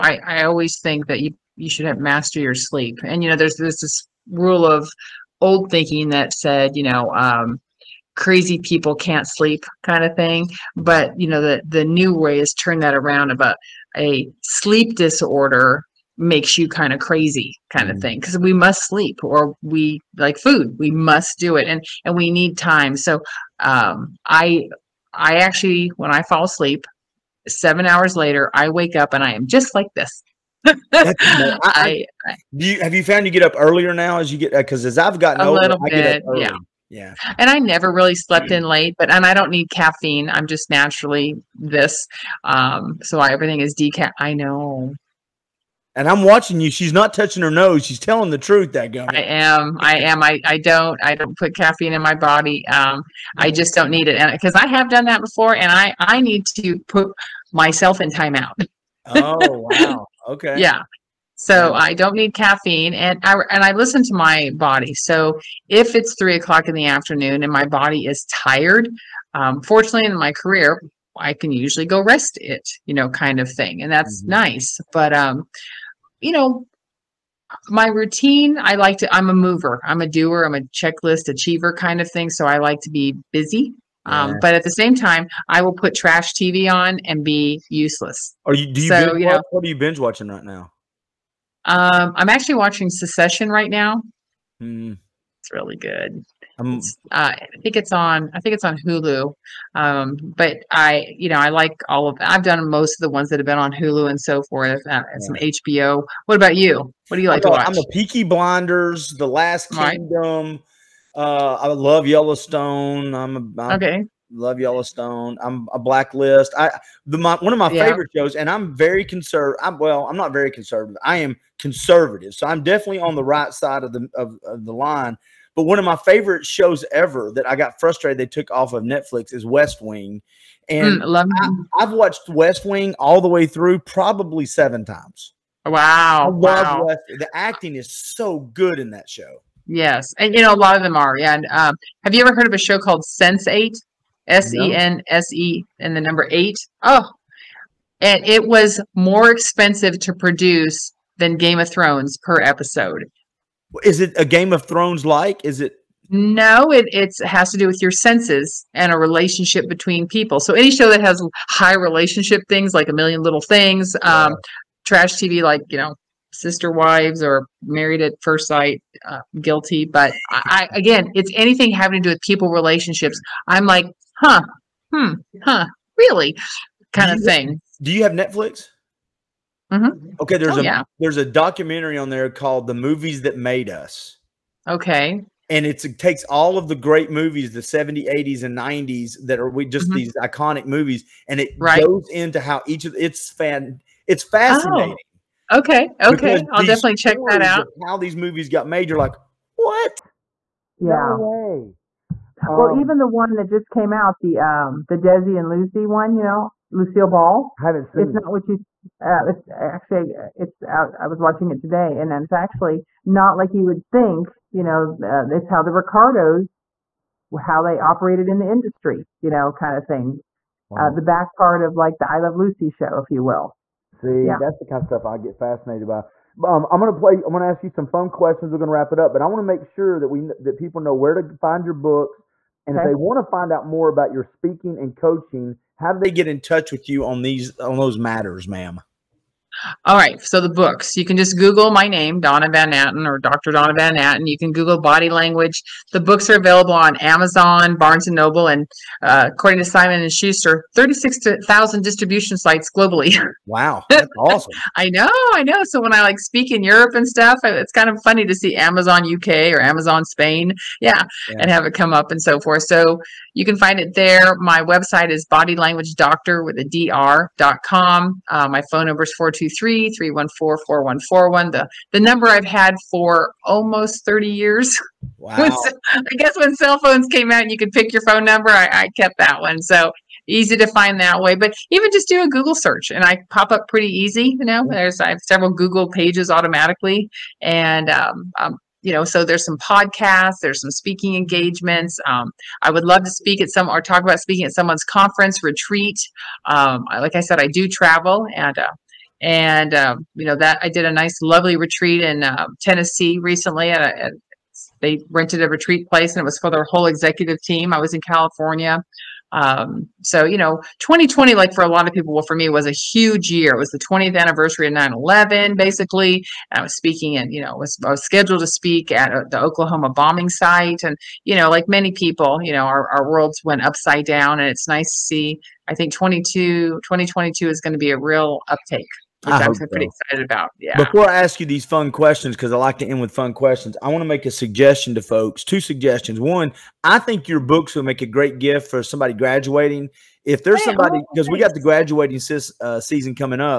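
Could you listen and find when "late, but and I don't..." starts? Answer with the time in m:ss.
0:38.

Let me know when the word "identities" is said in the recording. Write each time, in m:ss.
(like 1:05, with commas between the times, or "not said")
not said.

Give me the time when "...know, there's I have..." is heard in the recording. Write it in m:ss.
4:44.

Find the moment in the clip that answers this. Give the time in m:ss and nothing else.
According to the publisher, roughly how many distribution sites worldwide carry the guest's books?
4:10.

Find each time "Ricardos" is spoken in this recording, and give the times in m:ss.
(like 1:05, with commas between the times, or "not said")
3:35.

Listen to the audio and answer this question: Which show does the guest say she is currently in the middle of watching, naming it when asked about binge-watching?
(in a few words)
Succession.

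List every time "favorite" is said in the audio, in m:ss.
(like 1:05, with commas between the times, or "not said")
1:57, 2:05.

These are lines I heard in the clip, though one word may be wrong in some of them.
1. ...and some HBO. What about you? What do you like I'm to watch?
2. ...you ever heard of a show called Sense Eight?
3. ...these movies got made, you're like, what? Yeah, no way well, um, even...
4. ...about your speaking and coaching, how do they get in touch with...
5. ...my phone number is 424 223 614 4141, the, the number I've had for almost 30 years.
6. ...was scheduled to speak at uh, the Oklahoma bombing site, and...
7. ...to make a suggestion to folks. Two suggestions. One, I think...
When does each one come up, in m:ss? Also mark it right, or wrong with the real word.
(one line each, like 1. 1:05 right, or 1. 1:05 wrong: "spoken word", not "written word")
1. 1:45 right
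2. 2:22 right
3. 3:17 right
4. 3:53 right
5. 4:28 wrong: "314", not "614"
6. 5:17 right
7. 5:34 right.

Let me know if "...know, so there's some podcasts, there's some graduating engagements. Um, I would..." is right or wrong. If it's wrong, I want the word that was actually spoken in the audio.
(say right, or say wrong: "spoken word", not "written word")
wrong: "speaking", not "graduating".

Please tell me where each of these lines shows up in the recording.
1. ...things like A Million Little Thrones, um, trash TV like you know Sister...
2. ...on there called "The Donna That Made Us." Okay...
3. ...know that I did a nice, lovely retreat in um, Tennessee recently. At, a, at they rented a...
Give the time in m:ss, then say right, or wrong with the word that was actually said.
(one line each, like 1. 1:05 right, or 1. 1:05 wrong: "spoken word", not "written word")
1. 2:42 wrong: "Things", not "Thrones"
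2. 3:01 wrong: "Movies", not "Donna"
3. 5:00 right.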